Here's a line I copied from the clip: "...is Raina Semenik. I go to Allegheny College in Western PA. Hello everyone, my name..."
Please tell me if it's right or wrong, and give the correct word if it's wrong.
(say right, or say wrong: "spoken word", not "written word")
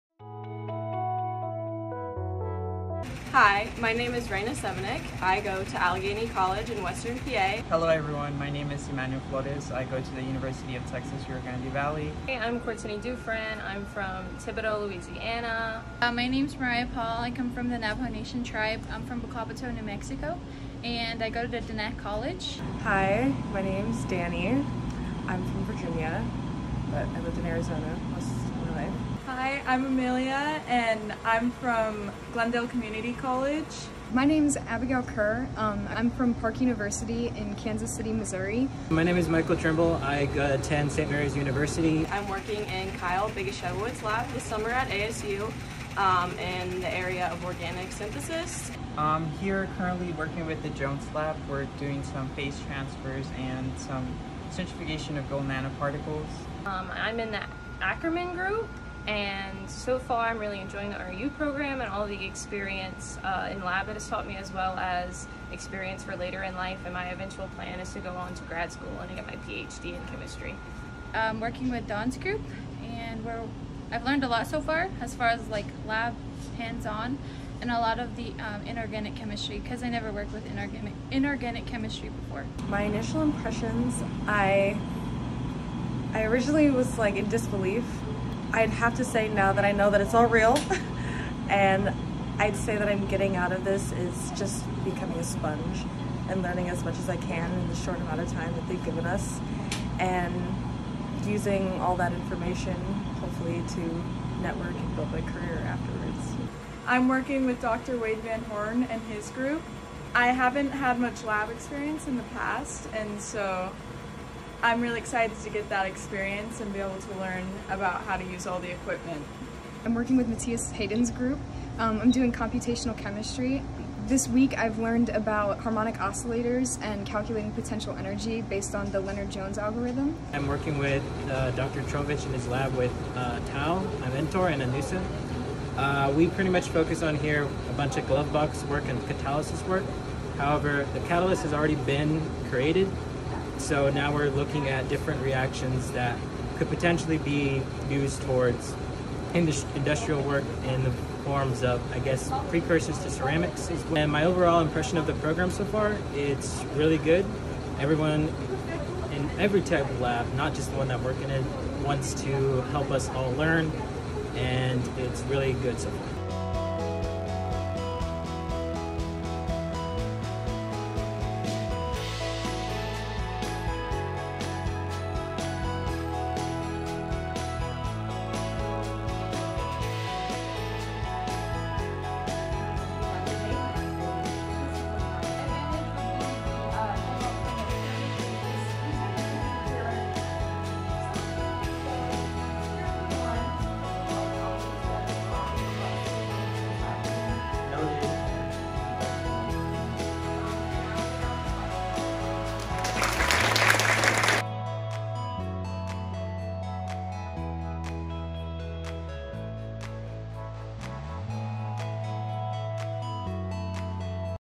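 right.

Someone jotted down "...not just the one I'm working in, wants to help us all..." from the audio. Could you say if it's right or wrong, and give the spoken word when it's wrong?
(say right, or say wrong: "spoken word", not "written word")
right.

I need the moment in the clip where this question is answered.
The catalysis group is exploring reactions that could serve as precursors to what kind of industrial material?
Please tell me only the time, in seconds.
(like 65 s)
153 s.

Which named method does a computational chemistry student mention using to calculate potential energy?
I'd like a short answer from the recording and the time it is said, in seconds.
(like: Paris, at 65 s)
Lennard-Jones, at 128 s.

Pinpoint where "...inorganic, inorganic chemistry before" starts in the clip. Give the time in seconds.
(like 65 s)
80 s.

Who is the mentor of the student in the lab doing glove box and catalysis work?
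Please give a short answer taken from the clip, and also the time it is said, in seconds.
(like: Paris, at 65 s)
Tao, at 133 s.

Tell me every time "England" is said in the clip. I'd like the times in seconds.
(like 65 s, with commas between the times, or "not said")
not said.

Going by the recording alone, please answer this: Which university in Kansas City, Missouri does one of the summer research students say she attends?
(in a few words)
Park University.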